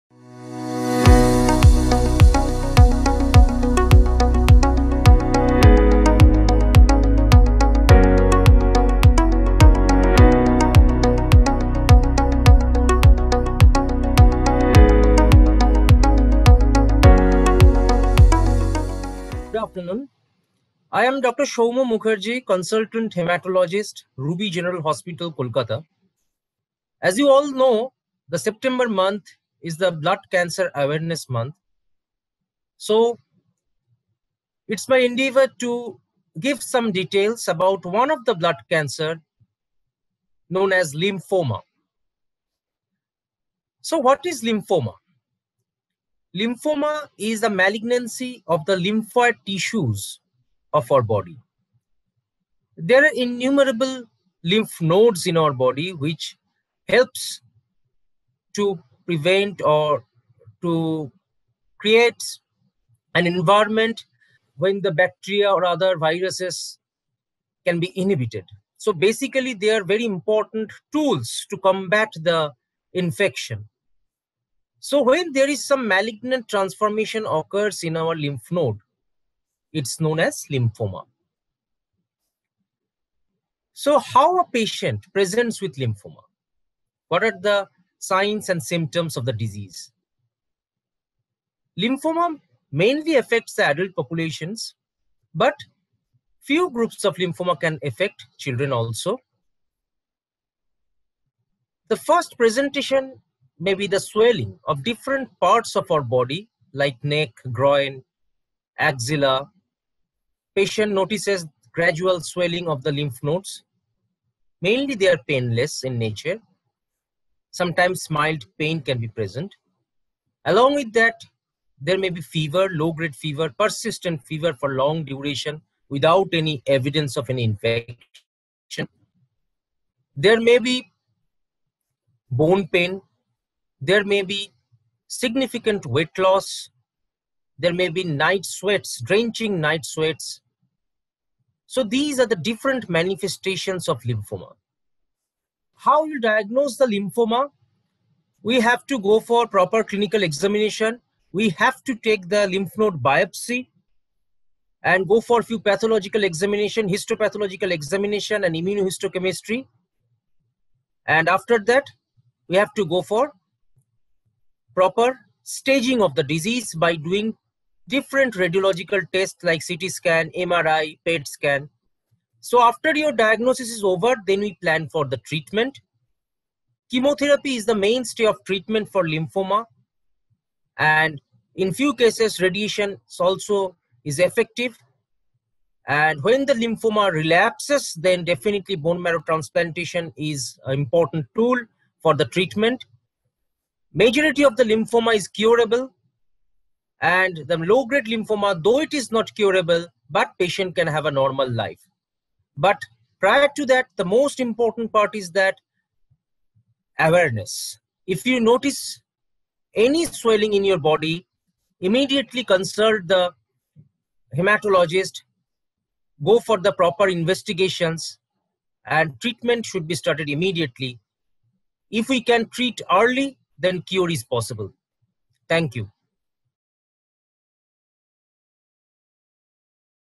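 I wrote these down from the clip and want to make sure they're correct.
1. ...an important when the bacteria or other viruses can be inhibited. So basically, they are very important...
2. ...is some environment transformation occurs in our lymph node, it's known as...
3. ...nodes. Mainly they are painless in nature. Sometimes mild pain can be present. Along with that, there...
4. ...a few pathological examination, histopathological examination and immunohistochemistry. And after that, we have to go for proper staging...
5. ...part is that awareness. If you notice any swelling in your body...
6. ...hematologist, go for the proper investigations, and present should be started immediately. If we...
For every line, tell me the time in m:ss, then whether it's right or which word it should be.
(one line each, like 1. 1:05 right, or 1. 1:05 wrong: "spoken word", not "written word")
1. 1:03 wrong: "environment", not "important"
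2. 1:15 wrong: "malignant", not "environment"
3. 1:53 right
4. 2:35 right
5. 3:24 right
6. 3:34 wrong: "treatment", not "present".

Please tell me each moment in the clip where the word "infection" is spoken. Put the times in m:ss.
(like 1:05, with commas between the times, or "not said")
1:12, 2:07.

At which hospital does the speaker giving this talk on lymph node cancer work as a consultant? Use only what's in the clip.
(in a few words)
Ruby General Hospital.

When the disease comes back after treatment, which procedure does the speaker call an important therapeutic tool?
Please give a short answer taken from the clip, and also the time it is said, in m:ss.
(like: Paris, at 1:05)
Bone marrow transplantation, at 3:08.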